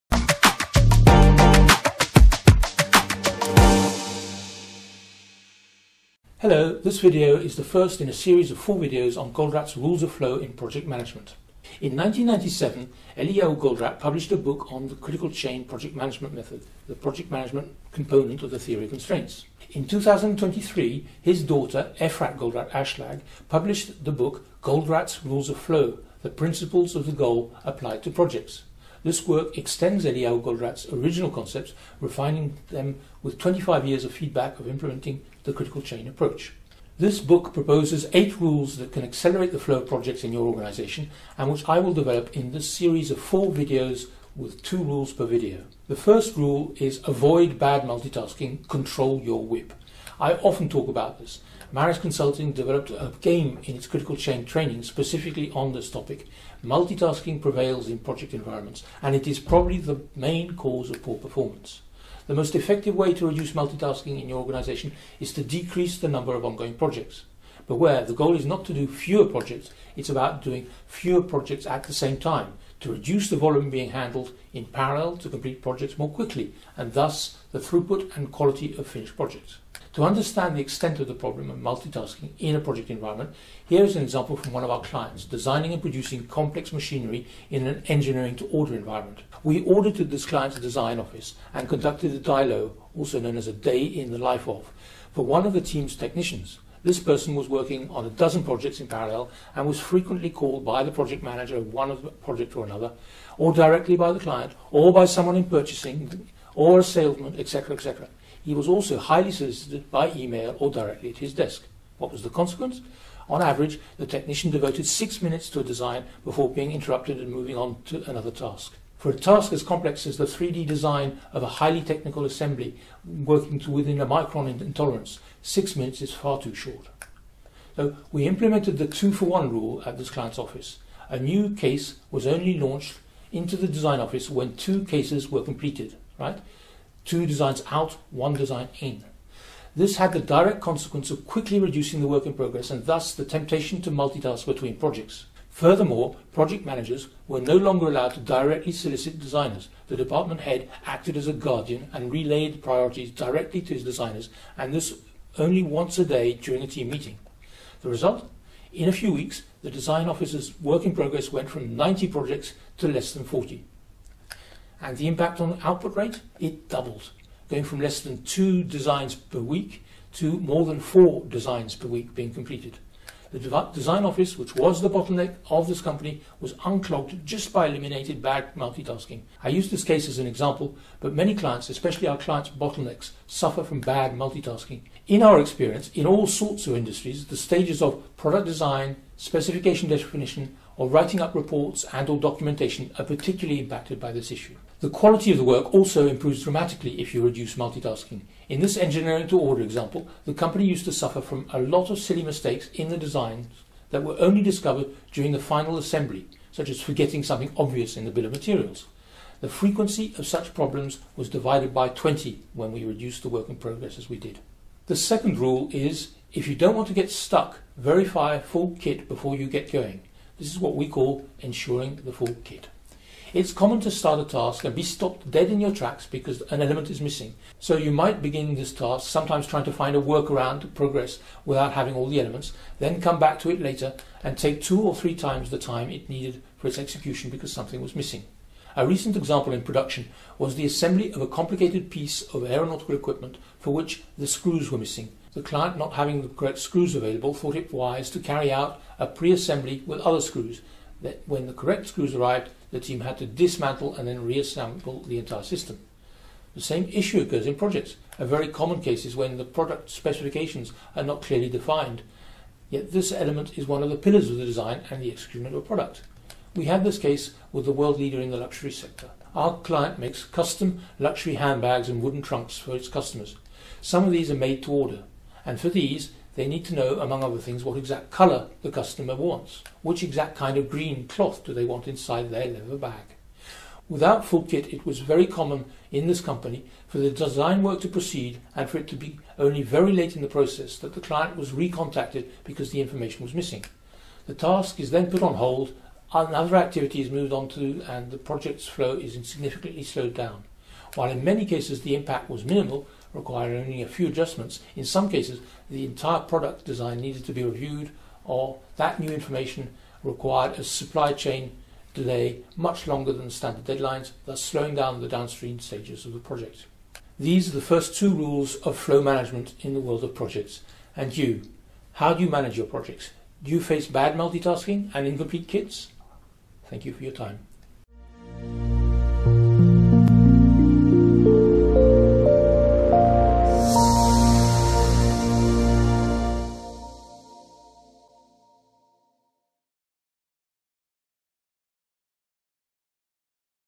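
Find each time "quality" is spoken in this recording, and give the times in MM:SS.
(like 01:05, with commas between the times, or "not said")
01:18, 03:14.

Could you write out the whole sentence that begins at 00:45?
The first rule is avoid bad multitasking, control your WIP.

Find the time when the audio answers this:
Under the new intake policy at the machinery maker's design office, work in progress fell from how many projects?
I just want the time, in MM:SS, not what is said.
02:41.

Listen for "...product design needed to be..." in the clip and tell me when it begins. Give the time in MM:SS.
05:06.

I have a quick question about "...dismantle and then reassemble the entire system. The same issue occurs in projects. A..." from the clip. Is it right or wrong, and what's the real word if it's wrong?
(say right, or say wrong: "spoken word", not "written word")
right.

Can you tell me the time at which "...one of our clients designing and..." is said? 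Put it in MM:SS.
01:24.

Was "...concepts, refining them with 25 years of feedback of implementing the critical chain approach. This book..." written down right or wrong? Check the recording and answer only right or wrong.
right.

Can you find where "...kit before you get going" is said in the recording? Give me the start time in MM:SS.
03:38.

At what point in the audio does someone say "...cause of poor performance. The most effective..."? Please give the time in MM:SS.
01:00.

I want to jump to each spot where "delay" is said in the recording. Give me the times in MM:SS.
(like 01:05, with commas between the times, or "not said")
05:11.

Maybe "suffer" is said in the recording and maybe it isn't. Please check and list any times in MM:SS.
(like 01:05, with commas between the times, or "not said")
03:03, 03:20.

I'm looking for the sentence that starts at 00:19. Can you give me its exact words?
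In 2023, his daughter, Efrat Goldratt Ashlag, published the book Goldratt's Rules of Flow, the principles of the goal applied to projects.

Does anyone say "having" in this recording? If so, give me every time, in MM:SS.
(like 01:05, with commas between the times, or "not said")
03:51, 04:05.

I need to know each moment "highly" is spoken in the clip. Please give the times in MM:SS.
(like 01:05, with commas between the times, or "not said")
01:48, 02:01.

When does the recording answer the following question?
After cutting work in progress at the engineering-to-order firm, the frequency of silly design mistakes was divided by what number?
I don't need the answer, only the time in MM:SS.
03:31.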